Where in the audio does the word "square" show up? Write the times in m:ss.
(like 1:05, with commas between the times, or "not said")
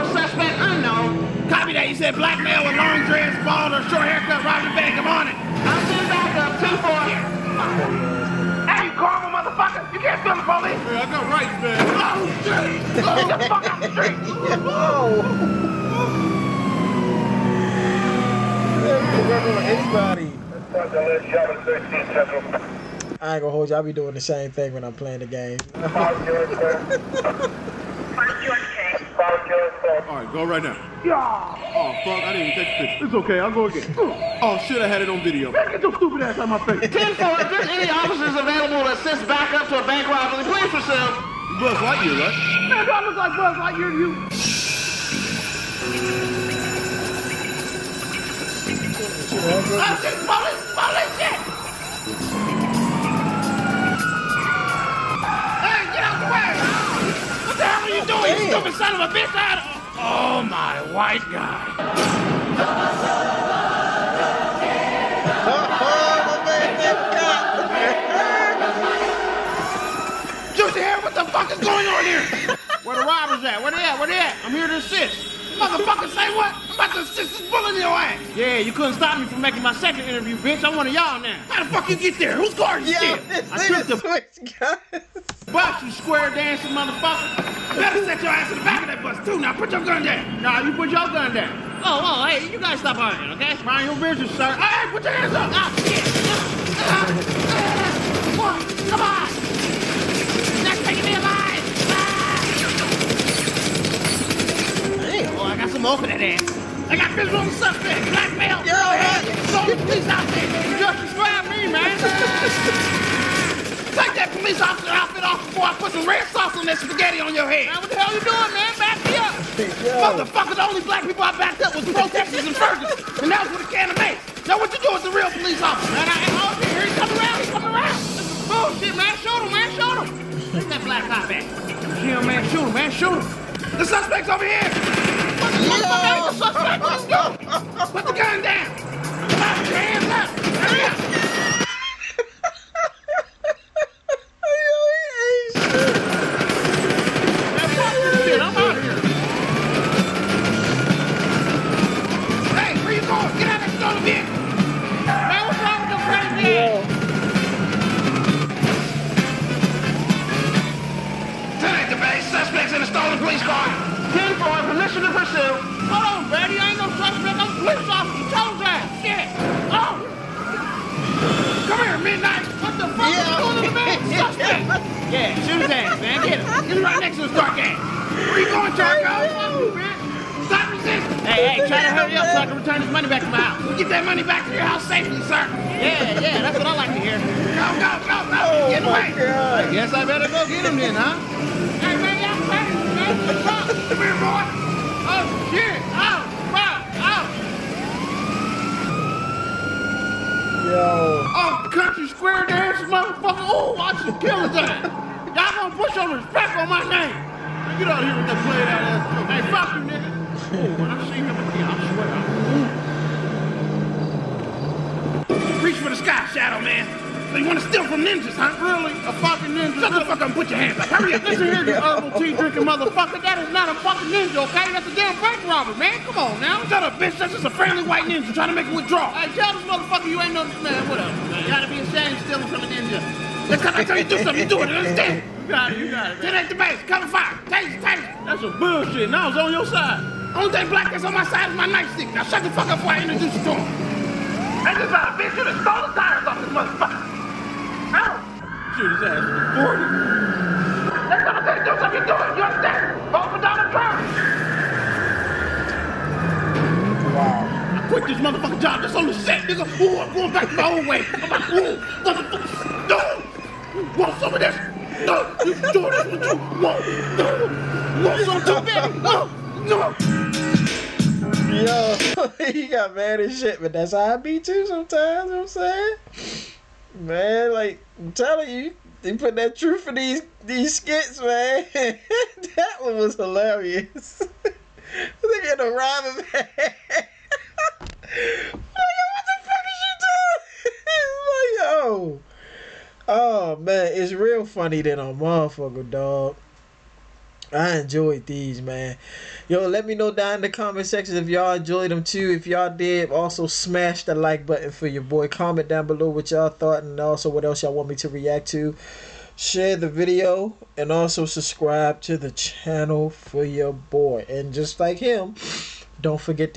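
1:25, 3:22.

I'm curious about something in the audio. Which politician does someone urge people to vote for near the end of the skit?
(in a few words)
Donald Trump.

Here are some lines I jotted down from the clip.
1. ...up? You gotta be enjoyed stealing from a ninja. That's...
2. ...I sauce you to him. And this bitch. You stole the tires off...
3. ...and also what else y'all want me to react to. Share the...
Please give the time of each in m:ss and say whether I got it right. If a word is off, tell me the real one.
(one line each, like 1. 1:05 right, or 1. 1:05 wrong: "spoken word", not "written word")
1. 3:51 wrong: "ashamed", not "enjoyed"
2. 4:02 wrong: "introduce", not "sauce"
3. 5:06 right.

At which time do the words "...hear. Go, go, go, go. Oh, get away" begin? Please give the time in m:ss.
3:06.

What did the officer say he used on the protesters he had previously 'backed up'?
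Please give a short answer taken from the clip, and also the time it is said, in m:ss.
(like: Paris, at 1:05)
a can of mace, at 2:03.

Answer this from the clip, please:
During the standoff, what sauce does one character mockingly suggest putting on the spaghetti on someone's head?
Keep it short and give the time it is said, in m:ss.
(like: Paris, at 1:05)
red sauce, at 1:56.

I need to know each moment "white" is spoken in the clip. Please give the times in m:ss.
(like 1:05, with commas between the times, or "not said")
1:00, 3:47.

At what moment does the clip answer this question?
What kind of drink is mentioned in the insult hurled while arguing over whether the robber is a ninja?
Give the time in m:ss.
3:41.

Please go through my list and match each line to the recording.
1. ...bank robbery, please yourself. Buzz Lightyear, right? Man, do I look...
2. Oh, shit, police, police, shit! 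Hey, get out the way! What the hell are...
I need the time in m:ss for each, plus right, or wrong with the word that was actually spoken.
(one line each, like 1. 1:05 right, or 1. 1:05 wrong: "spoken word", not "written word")
1. 0:39 right
2. 0:49 right.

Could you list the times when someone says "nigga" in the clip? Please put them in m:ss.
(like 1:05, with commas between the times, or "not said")
3:29, 4:19.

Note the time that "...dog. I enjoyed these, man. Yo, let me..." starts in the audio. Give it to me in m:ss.
4:55.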